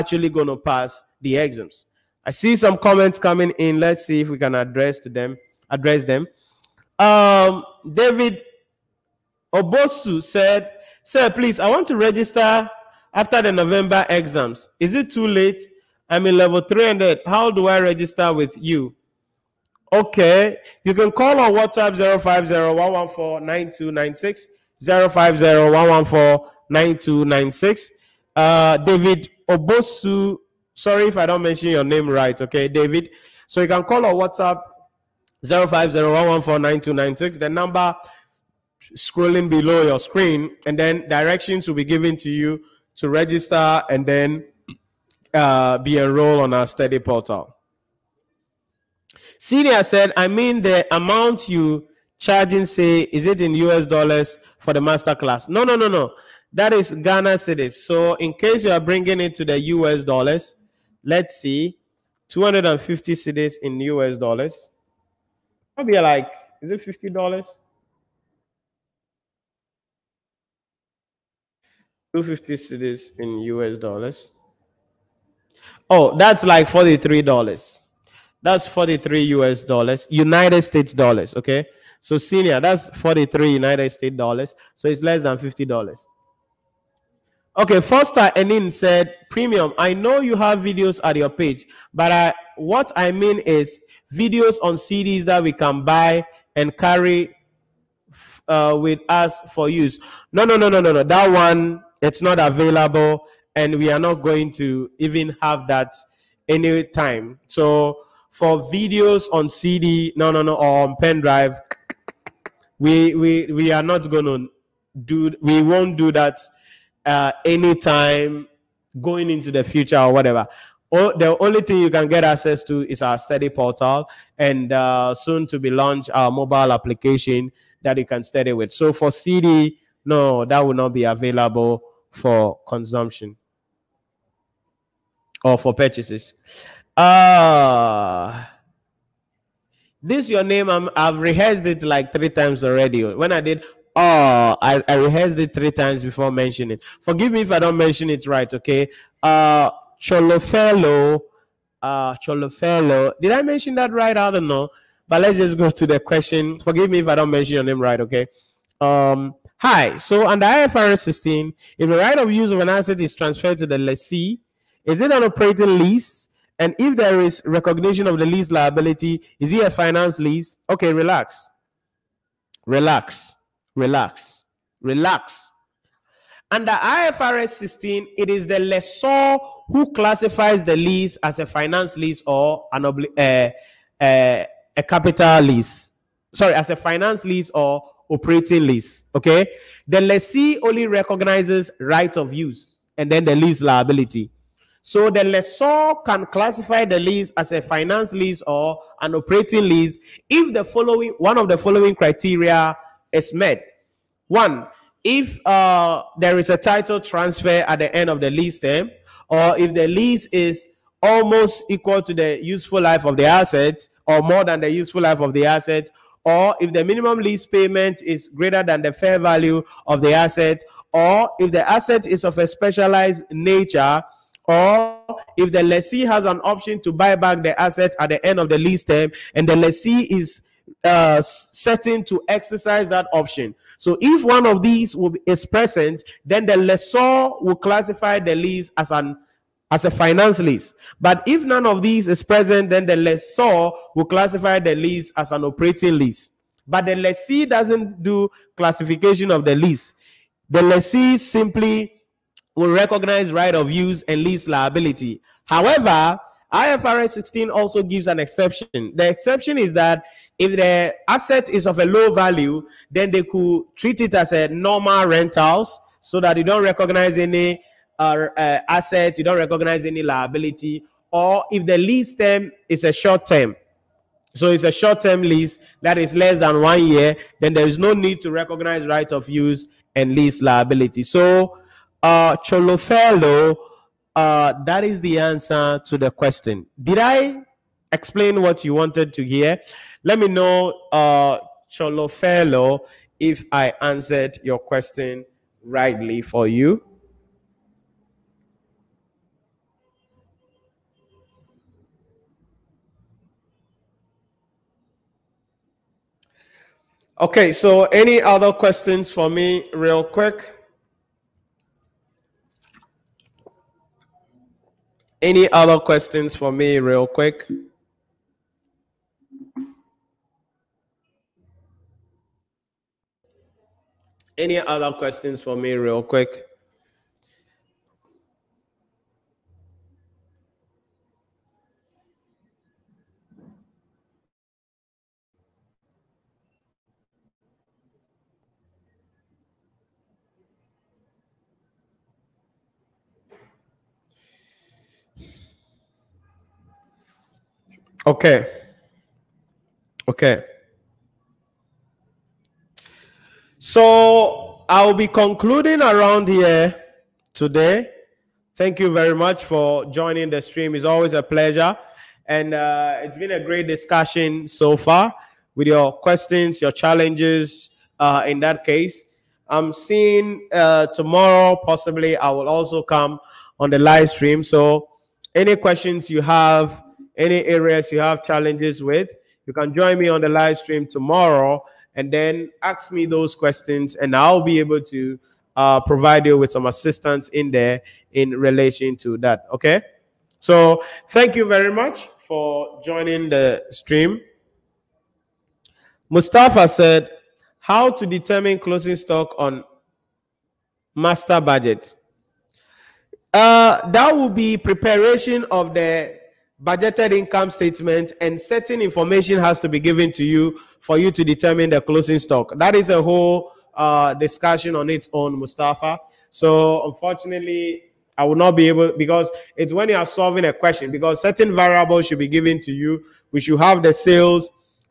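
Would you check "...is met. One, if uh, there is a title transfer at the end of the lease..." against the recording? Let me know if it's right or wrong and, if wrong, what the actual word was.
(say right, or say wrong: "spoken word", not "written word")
right.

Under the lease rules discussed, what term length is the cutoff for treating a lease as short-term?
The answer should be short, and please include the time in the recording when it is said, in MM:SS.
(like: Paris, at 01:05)
one year, at 04:36.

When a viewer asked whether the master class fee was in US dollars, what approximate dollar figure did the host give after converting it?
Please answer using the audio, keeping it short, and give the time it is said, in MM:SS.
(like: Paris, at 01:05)
$43, at 01:18.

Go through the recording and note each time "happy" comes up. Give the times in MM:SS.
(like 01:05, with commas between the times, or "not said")
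not said.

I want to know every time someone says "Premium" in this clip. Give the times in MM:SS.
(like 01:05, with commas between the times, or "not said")
01:29.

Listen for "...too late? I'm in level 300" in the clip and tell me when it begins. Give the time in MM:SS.
00:15.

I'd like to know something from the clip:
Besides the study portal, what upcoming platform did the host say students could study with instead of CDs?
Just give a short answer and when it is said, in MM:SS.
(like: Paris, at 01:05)
mobile application, at 02:06.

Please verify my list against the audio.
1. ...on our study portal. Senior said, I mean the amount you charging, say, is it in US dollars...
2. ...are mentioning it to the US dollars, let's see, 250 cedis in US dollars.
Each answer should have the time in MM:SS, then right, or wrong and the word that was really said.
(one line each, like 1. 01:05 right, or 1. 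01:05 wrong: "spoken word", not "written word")
1. 00:46 right
2. 00:58 wrong: "bringing", not "mentioning".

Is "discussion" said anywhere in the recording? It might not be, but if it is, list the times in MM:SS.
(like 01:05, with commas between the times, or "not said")
06:03, 06:54.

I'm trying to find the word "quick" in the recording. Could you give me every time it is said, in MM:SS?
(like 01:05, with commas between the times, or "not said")
05:10, 05:17, 05:26.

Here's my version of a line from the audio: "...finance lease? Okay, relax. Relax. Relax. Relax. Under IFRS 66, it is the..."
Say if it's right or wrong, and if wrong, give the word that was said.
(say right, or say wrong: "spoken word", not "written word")
wrong: "16", not "66".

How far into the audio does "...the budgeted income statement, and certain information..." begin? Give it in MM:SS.
06:45.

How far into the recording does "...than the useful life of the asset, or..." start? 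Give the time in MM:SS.
03:34.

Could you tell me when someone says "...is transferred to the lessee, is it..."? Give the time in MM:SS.
02:42.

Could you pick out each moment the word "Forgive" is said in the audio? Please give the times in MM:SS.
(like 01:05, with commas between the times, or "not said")
02:27, 02:36.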